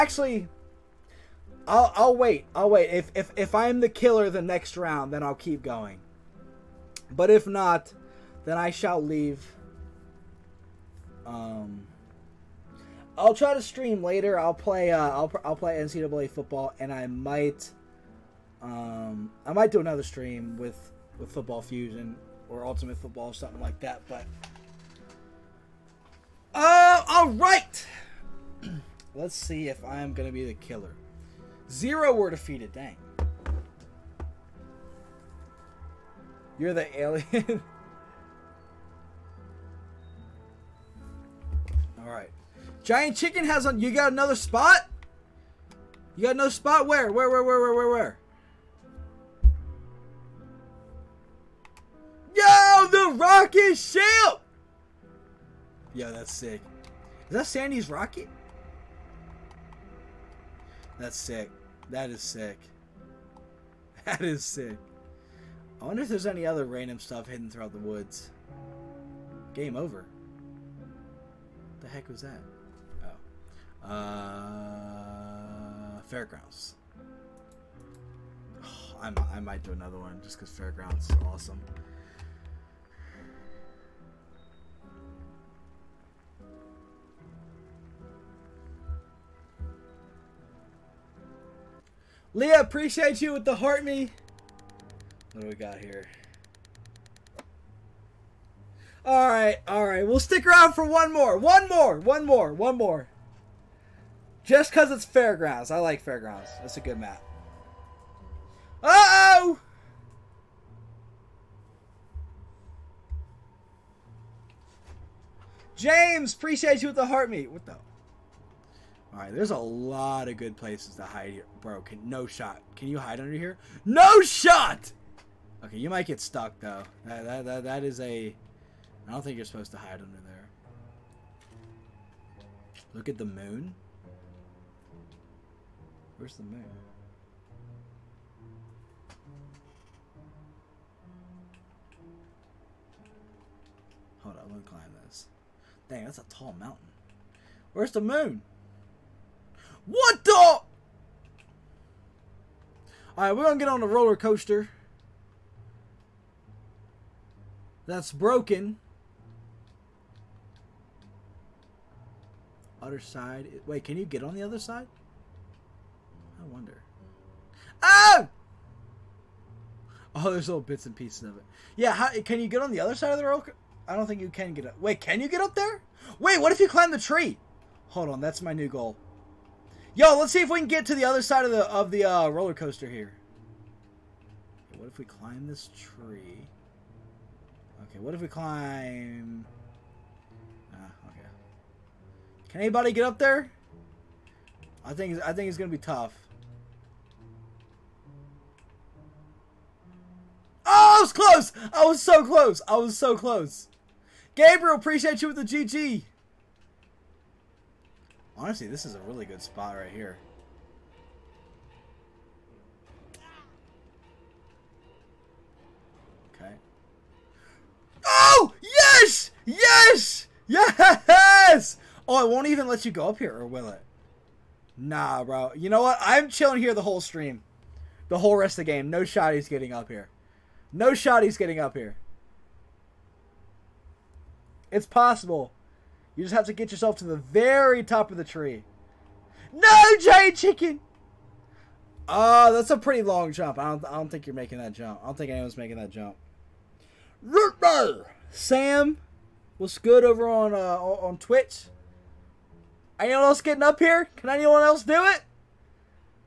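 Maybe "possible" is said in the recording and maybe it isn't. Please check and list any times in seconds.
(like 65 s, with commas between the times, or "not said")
234 s.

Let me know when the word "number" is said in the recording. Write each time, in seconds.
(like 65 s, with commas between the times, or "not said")
not said.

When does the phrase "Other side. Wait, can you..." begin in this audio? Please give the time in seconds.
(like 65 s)
162 s.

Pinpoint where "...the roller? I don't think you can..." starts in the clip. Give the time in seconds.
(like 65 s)
173 s.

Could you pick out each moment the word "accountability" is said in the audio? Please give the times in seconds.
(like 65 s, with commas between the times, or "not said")
not said.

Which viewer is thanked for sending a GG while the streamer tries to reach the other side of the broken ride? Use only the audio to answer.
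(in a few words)
Gabriel.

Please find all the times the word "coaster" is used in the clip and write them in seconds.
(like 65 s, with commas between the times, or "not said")
154 s, 182 s.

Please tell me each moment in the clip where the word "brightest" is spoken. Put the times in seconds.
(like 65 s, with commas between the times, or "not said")
not said.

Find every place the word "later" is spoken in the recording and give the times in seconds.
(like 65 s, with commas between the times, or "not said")
14 s.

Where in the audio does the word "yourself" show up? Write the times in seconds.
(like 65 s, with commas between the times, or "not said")
236 s.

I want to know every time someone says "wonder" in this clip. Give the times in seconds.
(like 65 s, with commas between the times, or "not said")
65 s, 166 s.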